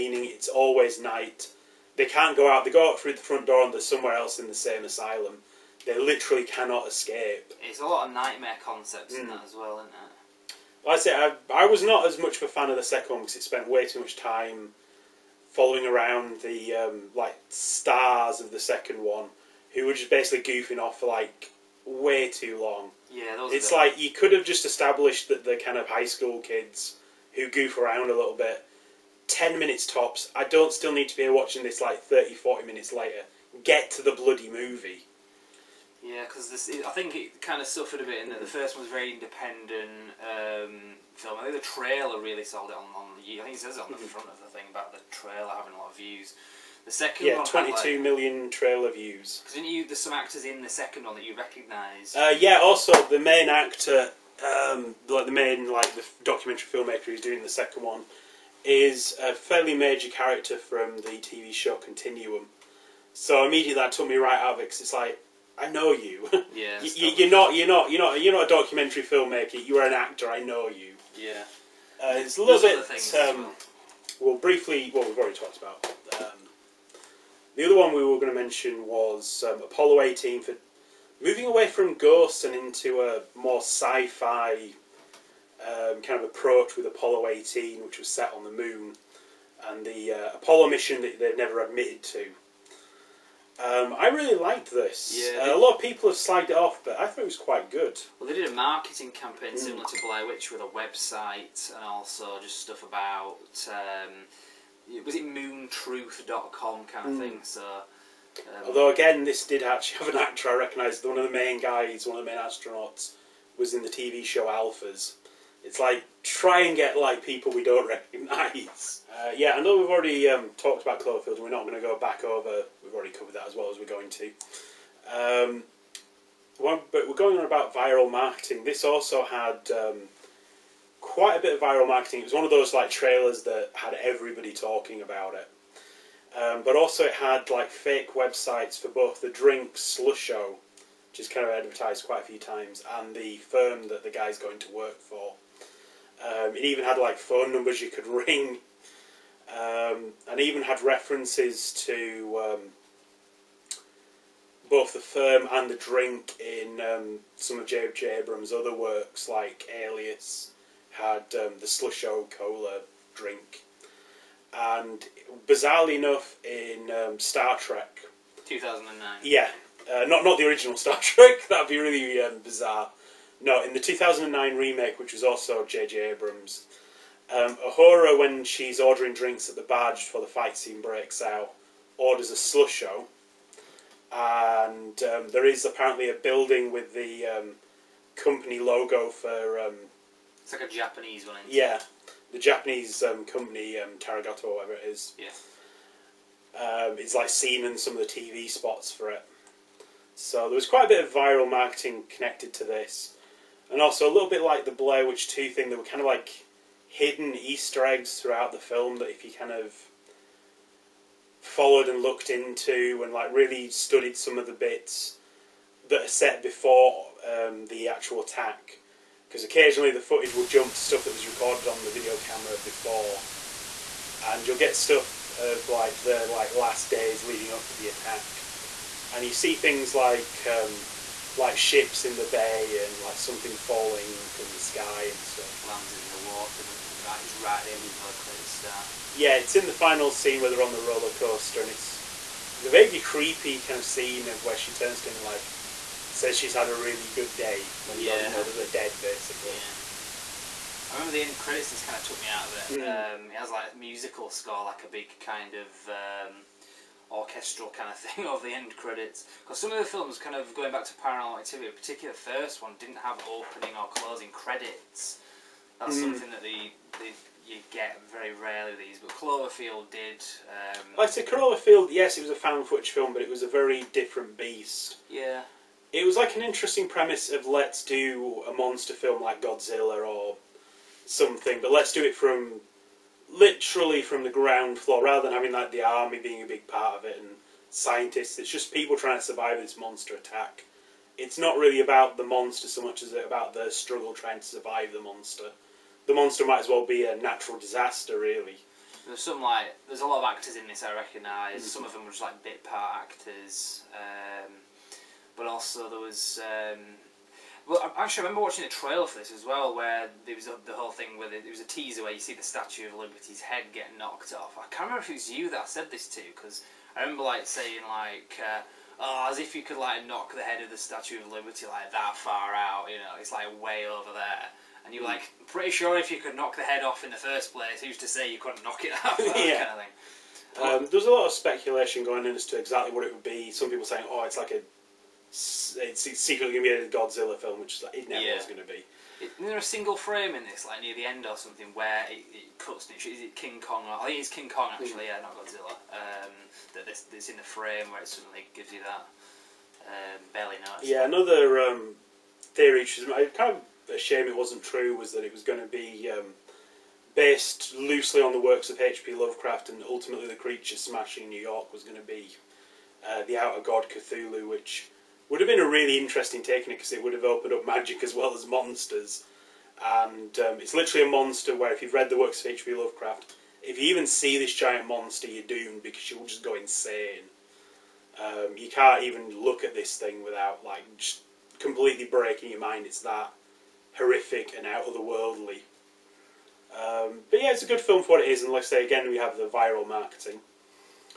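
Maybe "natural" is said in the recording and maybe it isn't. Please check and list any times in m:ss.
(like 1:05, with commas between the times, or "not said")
4:57.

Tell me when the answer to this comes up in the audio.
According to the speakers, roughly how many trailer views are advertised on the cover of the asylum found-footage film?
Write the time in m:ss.
0:47.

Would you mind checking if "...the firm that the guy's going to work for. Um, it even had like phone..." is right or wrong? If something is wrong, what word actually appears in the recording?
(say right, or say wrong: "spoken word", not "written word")
right.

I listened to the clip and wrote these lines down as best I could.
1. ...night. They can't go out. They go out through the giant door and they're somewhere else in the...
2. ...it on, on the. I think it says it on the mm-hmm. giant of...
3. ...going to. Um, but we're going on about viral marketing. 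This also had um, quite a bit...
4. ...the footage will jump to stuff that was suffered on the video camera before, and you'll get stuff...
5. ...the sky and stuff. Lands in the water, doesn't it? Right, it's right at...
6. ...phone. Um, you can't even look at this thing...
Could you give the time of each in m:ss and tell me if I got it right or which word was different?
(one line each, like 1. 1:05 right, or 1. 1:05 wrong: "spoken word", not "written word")
1. 0:00 wrong: "front", not "giant"
2. 0:42 wrong: "front", not "giant"
3. 2:03 right
4. 3:39 wrong: "recorded", not "suffered"
5. 3:54 right
6. 6:16 wrong: "insane", not "phone".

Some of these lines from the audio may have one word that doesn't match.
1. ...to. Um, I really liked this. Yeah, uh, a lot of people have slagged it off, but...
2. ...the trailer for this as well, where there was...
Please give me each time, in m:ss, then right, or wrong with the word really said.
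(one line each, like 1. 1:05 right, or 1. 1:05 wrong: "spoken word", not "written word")
1. 1:32 right
2. 5:08 right.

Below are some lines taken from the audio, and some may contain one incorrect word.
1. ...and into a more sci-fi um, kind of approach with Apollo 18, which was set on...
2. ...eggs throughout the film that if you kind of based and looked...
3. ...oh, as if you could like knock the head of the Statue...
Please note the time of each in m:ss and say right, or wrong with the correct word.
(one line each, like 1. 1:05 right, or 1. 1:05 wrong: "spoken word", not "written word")
1. 1:22 right
2. 3:27 wrong: "followed", not "based"
3. 5:18 right.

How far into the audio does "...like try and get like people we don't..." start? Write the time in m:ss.
1:55.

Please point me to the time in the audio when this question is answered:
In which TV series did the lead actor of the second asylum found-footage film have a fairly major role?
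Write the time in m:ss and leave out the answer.
1:01.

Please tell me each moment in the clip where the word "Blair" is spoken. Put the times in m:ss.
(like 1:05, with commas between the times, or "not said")
1:40, 3:24.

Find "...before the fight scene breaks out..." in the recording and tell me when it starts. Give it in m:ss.
3:00.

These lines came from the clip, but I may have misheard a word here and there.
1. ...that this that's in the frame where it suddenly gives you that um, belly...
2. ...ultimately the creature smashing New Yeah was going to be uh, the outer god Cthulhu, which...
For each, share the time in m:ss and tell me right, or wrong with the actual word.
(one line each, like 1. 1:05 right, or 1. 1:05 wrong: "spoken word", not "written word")
1. 5:46 right
2. 5:59 wrong: "York", not "Yeah".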